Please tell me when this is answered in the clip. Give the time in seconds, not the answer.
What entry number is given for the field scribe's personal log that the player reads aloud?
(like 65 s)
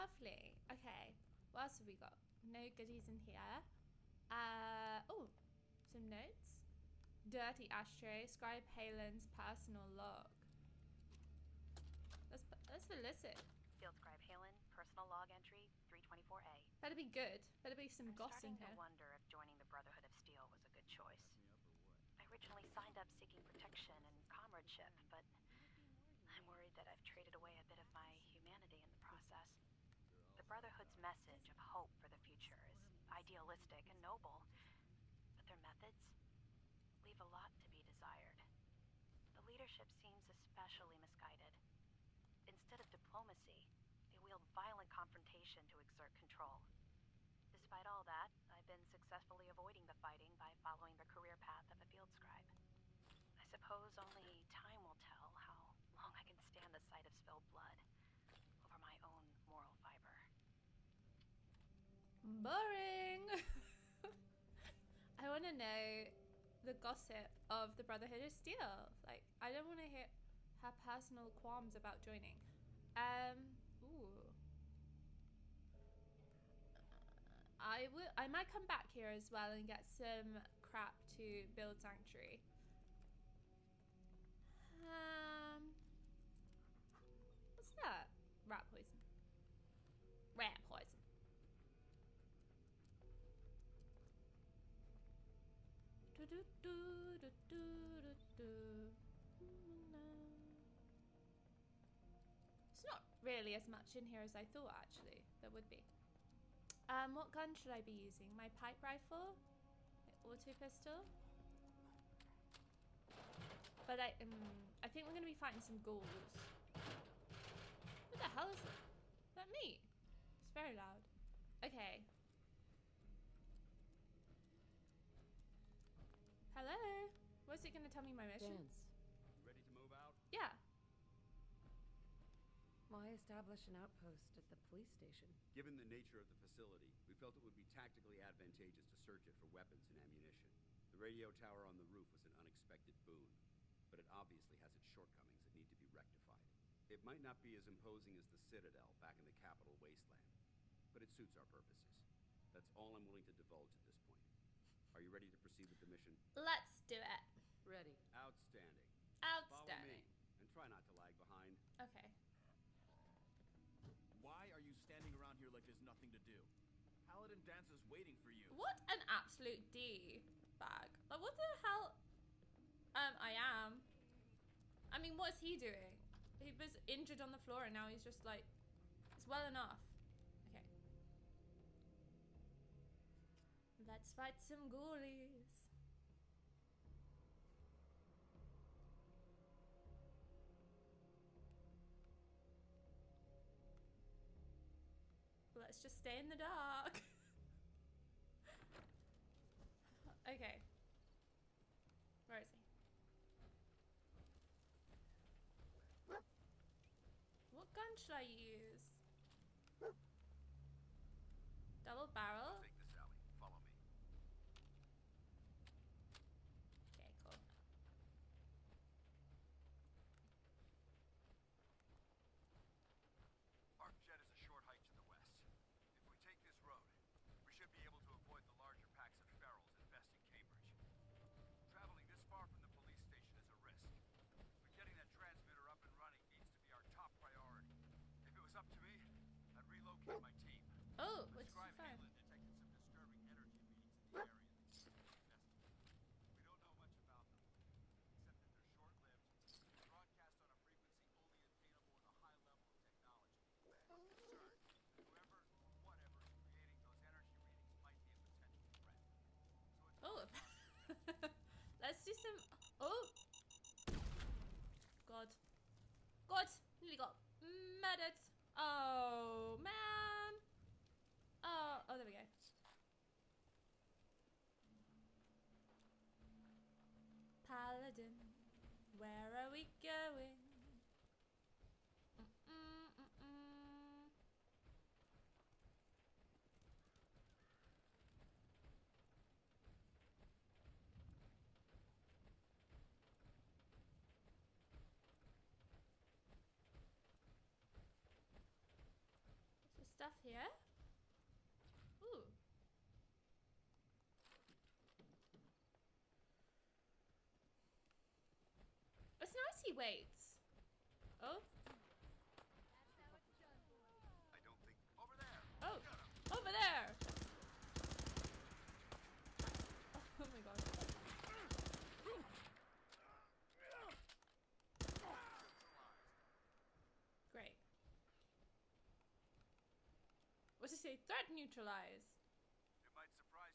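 15 s.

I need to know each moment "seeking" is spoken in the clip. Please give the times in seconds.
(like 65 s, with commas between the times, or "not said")
23 s.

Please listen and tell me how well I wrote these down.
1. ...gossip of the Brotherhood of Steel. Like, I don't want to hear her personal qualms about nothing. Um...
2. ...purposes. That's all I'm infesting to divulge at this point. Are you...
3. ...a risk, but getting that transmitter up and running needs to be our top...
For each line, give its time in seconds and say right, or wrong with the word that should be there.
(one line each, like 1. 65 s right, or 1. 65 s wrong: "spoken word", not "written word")
1. 66 s wrong: "joining", not "nothing"
2. 151 s wrong: "willing", not "infesting"
3. 233 s right.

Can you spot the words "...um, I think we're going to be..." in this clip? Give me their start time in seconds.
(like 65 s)
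114 s.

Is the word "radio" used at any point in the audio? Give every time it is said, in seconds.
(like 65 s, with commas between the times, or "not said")
140 s.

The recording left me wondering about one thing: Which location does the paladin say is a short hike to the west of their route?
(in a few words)
Arc Jet.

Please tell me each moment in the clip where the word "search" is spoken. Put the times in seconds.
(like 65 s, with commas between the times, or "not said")
138 s.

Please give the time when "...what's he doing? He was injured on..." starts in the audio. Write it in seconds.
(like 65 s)
175 s.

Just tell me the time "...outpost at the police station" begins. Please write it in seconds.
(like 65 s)
133 s.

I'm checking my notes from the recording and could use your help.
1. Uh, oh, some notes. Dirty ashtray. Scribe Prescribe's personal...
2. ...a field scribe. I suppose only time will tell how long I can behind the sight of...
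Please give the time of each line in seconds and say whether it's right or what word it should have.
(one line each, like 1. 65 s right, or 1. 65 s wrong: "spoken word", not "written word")
1. 4 s wrong: "Haylen", not "Prescribe"
2. 51 s wrong: "stand", not "behind".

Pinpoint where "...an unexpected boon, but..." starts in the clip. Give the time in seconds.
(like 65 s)
142 s.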